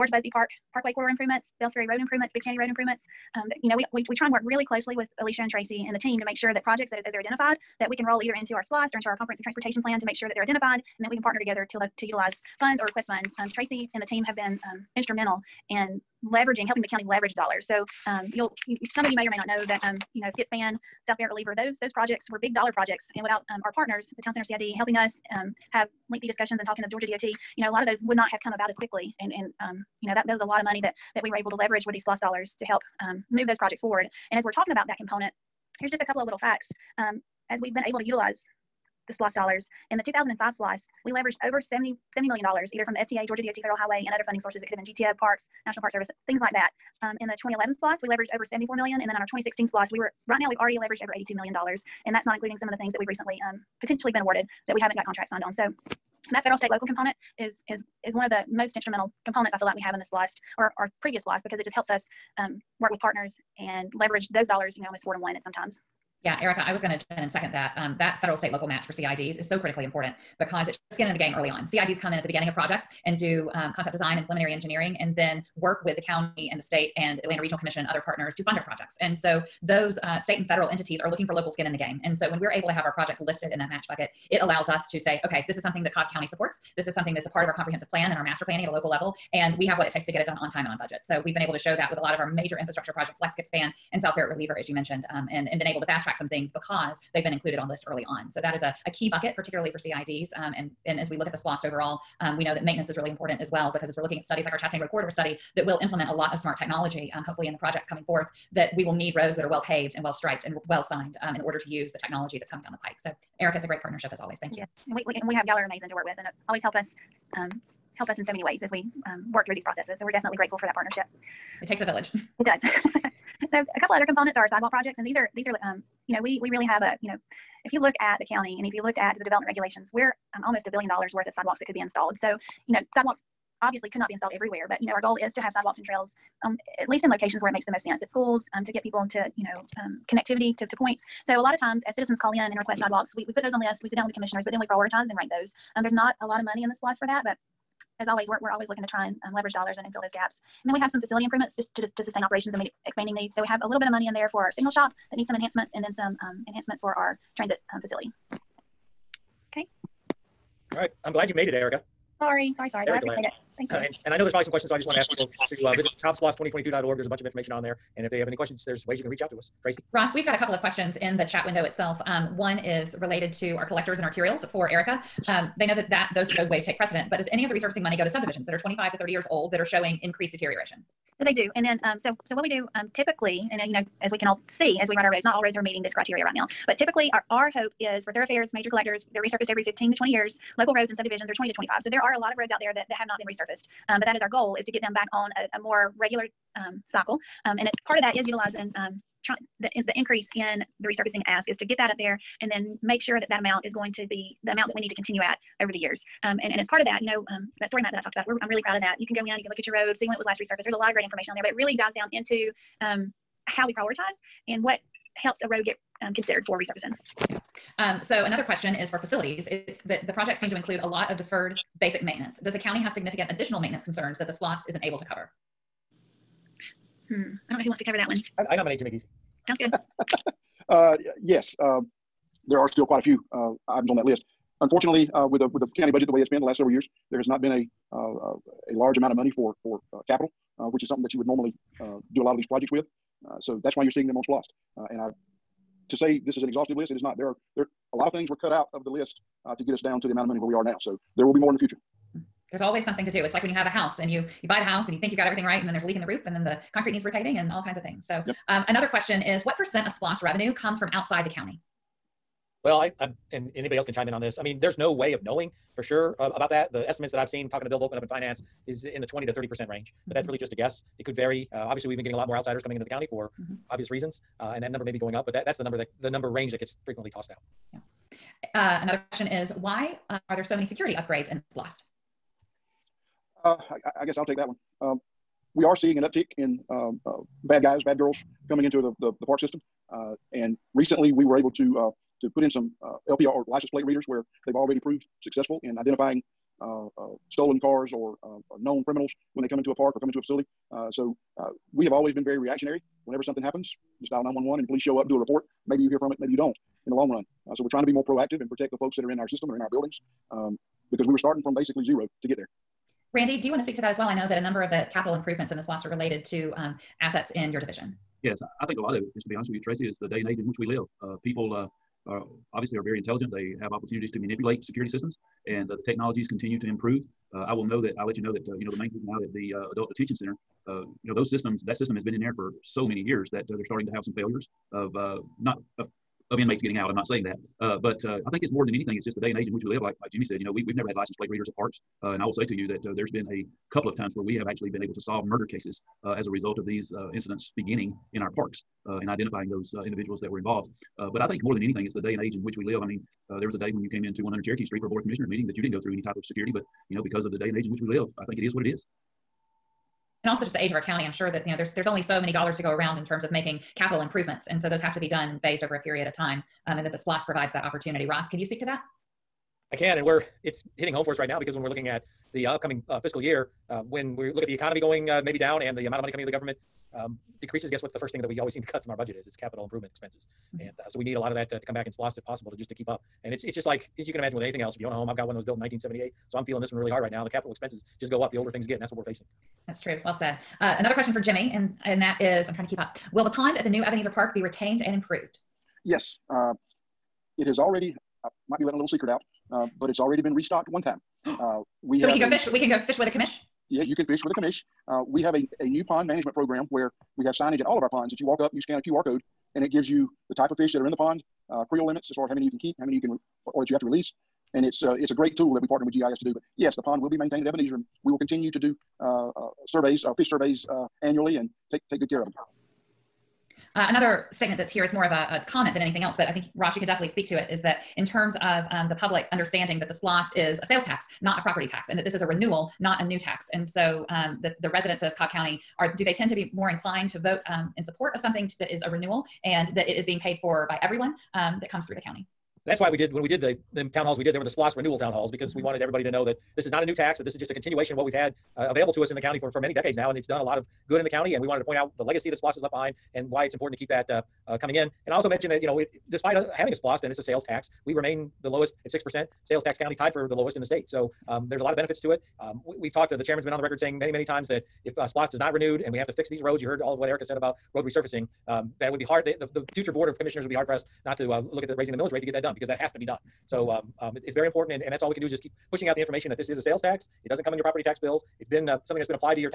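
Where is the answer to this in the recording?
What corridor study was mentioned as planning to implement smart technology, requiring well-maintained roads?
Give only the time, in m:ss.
1:44.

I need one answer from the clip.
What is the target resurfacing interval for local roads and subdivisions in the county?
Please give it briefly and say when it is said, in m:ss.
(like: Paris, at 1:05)
20 to 25 years, at 3:11.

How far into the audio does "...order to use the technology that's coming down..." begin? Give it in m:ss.
1:51.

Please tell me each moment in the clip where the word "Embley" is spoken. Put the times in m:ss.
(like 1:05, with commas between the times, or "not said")
not said.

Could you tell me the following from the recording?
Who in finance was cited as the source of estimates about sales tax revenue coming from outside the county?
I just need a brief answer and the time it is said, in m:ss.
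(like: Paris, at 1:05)
Bill Volckmann, at 4:27.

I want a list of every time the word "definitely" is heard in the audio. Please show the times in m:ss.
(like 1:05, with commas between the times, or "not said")
2:00, 7:06.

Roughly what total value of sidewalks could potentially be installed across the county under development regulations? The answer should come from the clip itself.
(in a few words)
almost a billion dollars.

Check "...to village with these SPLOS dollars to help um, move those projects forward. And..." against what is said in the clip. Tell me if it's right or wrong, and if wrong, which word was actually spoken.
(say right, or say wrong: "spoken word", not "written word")
wrong: "leverage", not "village".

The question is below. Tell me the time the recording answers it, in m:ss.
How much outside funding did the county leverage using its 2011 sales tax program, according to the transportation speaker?
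0:48.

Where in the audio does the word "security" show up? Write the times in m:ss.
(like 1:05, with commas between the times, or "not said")
4:40, 5:24, 5:56.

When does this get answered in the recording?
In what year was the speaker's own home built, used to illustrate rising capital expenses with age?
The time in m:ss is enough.
6:25.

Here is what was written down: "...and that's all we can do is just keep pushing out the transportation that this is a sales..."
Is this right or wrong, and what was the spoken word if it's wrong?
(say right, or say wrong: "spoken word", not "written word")
wrong: "information", not "transportation".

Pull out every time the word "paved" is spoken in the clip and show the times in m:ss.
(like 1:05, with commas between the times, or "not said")
1:49.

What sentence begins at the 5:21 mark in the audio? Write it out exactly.
Uh, people uh, are obviously are very intelligent.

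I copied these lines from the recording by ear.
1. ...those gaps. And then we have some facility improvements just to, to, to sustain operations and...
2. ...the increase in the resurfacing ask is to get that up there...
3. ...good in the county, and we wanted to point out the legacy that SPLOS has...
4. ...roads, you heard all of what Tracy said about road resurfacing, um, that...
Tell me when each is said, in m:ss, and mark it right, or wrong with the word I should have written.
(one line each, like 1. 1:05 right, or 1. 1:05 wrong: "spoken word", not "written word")
1. 2:30 right
2. 3:19 right
3. 7:30 right
4. 7:46 wrong: "Erica", not "Tracy".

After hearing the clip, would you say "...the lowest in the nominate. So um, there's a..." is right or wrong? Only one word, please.
wrong.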